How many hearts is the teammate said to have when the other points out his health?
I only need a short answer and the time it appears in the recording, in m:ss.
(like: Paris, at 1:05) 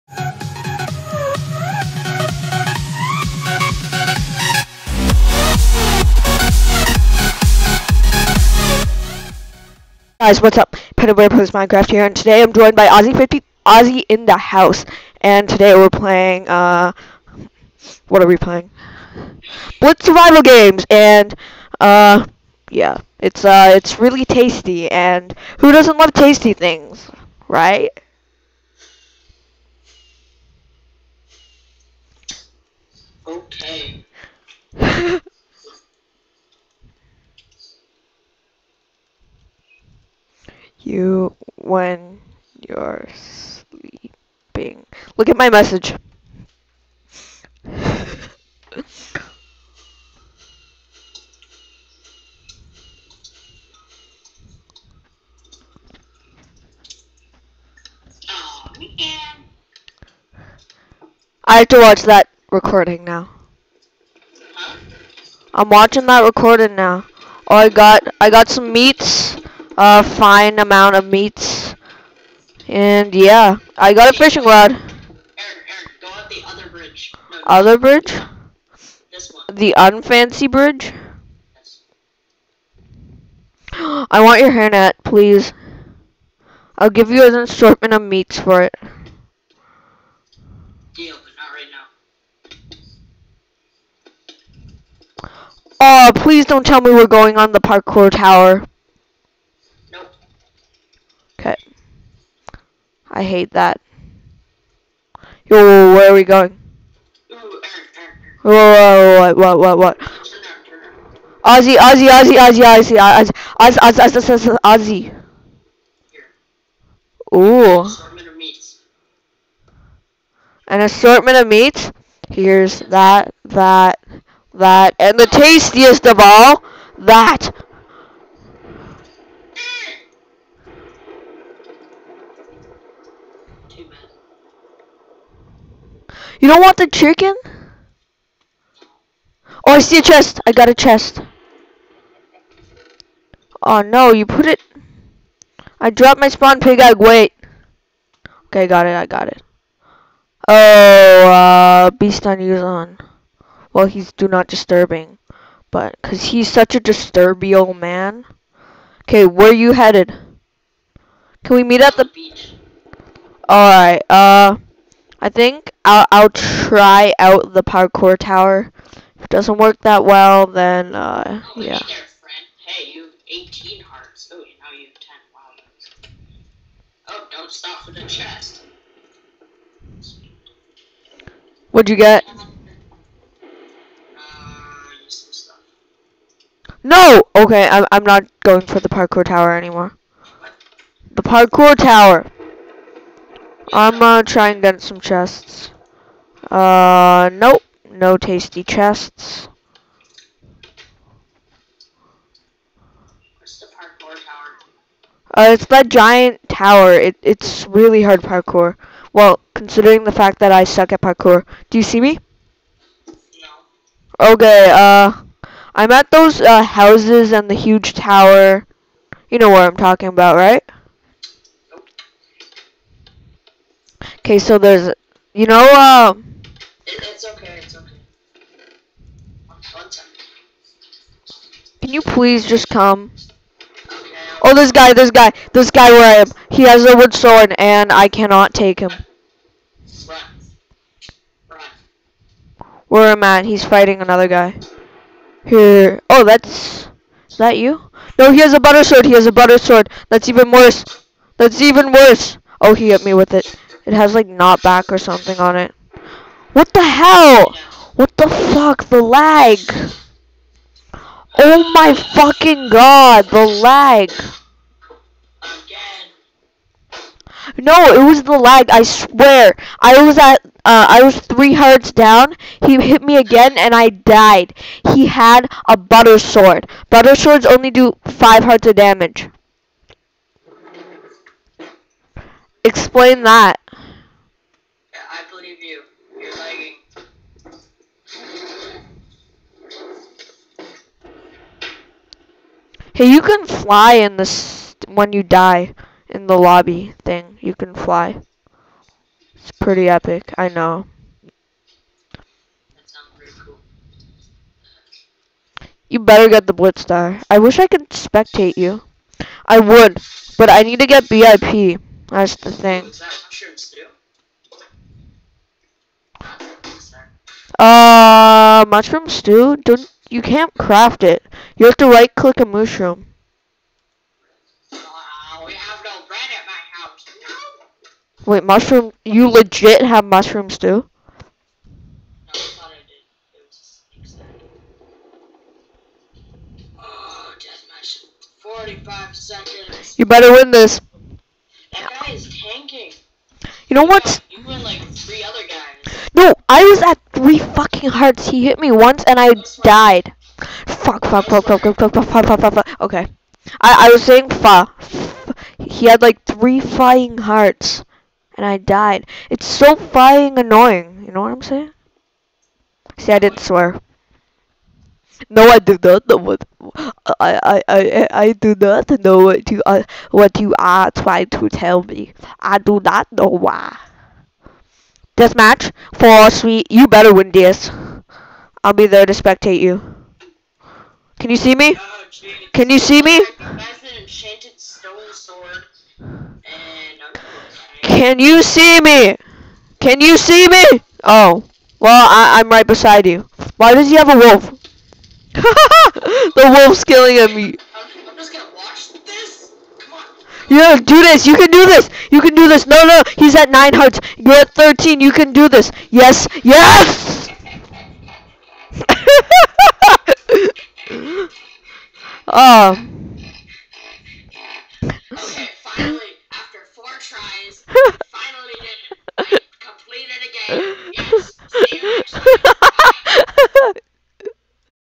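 18, at 2:53.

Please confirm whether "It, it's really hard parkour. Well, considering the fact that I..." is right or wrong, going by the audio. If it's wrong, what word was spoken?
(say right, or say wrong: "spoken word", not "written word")
right.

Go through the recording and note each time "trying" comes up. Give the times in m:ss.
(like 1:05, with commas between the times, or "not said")
6:10.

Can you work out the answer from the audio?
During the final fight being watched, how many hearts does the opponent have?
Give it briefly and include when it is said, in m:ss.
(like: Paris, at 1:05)
9, at 6:43.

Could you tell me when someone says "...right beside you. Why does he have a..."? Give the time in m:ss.
6:32.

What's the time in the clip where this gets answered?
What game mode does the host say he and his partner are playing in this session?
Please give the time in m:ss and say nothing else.
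0:19.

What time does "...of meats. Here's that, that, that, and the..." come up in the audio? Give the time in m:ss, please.
2:01.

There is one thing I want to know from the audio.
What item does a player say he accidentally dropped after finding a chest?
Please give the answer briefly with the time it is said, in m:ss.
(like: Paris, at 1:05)
Spawn pig egg, at 2:26.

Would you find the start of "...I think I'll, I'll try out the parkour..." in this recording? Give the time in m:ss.
2:45.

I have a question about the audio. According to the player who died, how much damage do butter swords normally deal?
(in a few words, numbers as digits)
5 hearts.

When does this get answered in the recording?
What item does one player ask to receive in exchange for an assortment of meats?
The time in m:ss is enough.
1:24.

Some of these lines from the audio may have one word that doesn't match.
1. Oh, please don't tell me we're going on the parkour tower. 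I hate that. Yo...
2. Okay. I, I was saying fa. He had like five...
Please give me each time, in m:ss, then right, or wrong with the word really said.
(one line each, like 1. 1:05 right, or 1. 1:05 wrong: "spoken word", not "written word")
1. 1:35 right
2. 5:52 wrong: "three", not "five".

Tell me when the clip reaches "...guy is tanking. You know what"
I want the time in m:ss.
5:42.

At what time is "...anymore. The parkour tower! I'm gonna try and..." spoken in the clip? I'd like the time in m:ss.
3:09.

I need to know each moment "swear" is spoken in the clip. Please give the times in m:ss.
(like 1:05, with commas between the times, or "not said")
4:28, 6:03.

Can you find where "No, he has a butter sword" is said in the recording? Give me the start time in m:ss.
4:08.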